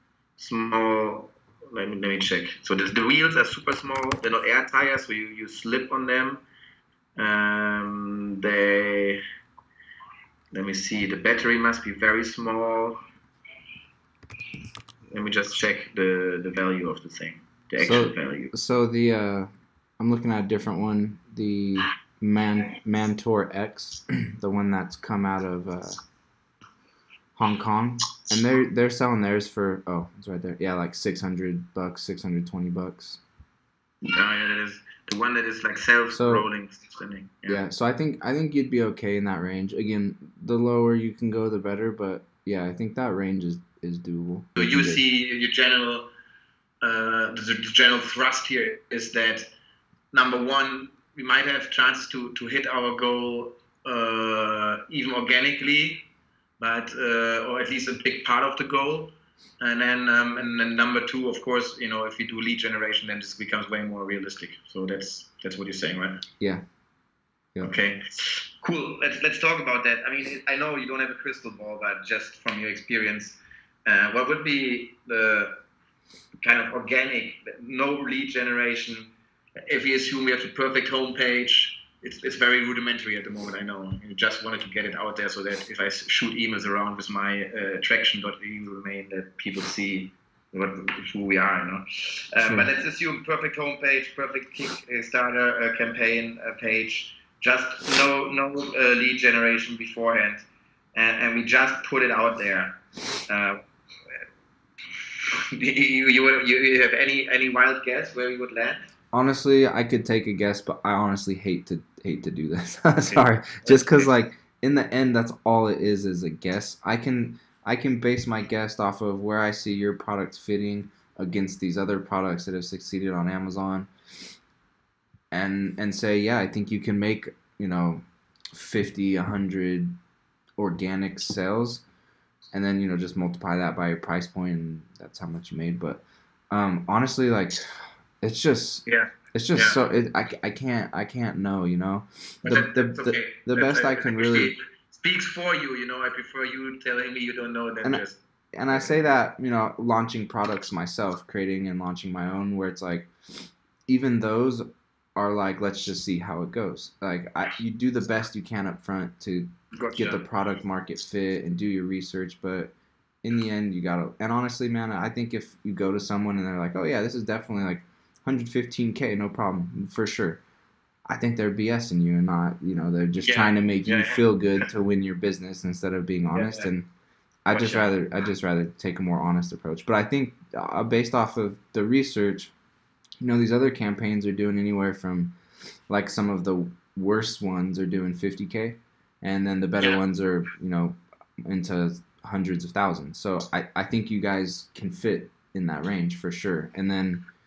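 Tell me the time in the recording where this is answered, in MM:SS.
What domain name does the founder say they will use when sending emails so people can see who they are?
01:27.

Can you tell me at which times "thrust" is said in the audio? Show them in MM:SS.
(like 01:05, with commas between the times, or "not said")
00:47.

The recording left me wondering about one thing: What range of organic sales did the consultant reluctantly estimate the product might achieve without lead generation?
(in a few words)
50 to 100.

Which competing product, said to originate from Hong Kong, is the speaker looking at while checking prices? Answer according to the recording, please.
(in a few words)
Mantor X.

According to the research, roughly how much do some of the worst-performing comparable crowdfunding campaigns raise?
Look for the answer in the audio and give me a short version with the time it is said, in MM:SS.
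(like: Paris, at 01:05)
50k, at 03:08.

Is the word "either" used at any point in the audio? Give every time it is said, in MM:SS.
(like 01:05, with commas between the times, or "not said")
not said.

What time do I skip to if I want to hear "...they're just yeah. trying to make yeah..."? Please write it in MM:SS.
02:52.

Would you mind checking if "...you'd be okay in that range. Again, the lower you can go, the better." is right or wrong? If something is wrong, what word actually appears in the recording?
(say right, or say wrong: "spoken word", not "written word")
right.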